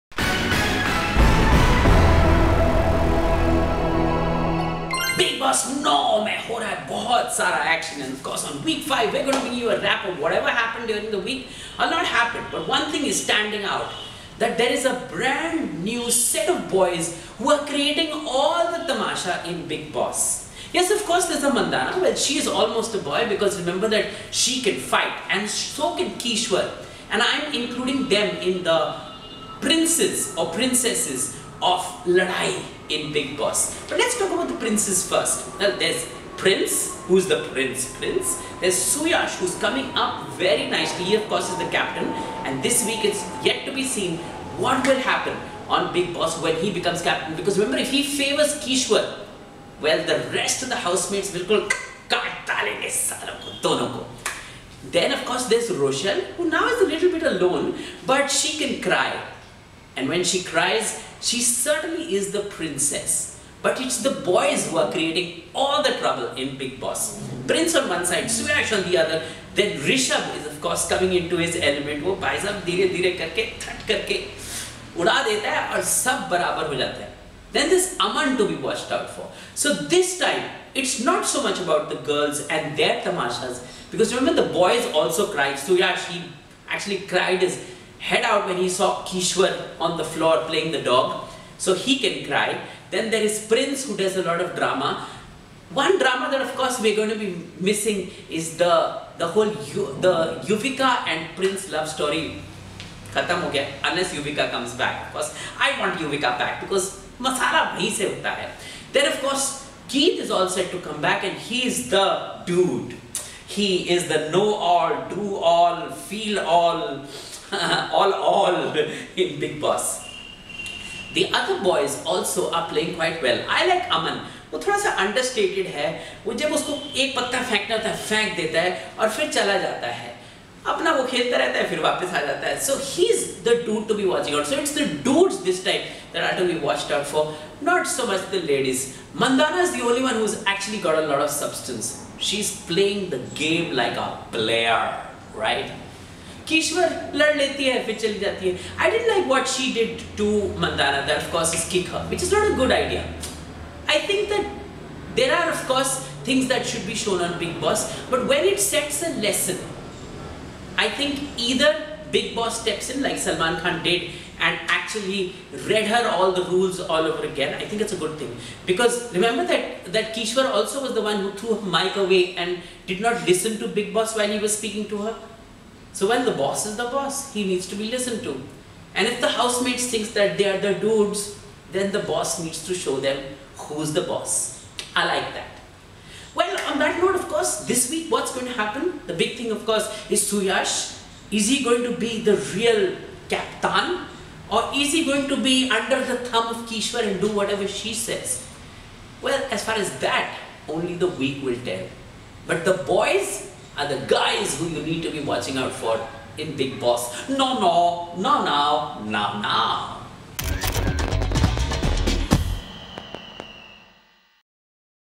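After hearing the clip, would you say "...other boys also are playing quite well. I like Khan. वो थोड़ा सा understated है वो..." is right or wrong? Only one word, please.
wrong.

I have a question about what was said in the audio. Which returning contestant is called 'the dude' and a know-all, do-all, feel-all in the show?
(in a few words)
Keith.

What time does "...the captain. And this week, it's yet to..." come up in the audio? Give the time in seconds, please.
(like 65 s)
41 s.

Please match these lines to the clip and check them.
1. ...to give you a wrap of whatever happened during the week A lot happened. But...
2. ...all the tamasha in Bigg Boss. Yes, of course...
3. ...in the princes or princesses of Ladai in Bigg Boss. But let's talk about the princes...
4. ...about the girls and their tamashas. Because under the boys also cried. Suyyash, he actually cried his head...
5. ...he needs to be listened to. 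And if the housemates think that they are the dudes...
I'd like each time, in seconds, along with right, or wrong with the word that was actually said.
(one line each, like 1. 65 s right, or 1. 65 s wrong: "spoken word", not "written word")
1. 9 s right
2. 18 s right
3. 28 s right
4. 81 s wrong: "remember", not "under"
5. 177 s right.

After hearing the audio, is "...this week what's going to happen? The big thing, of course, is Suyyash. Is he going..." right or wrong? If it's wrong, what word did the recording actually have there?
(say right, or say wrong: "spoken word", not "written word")
right.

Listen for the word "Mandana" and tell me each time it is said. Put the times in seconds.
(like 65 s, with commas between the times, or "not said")
21 s, 150 s.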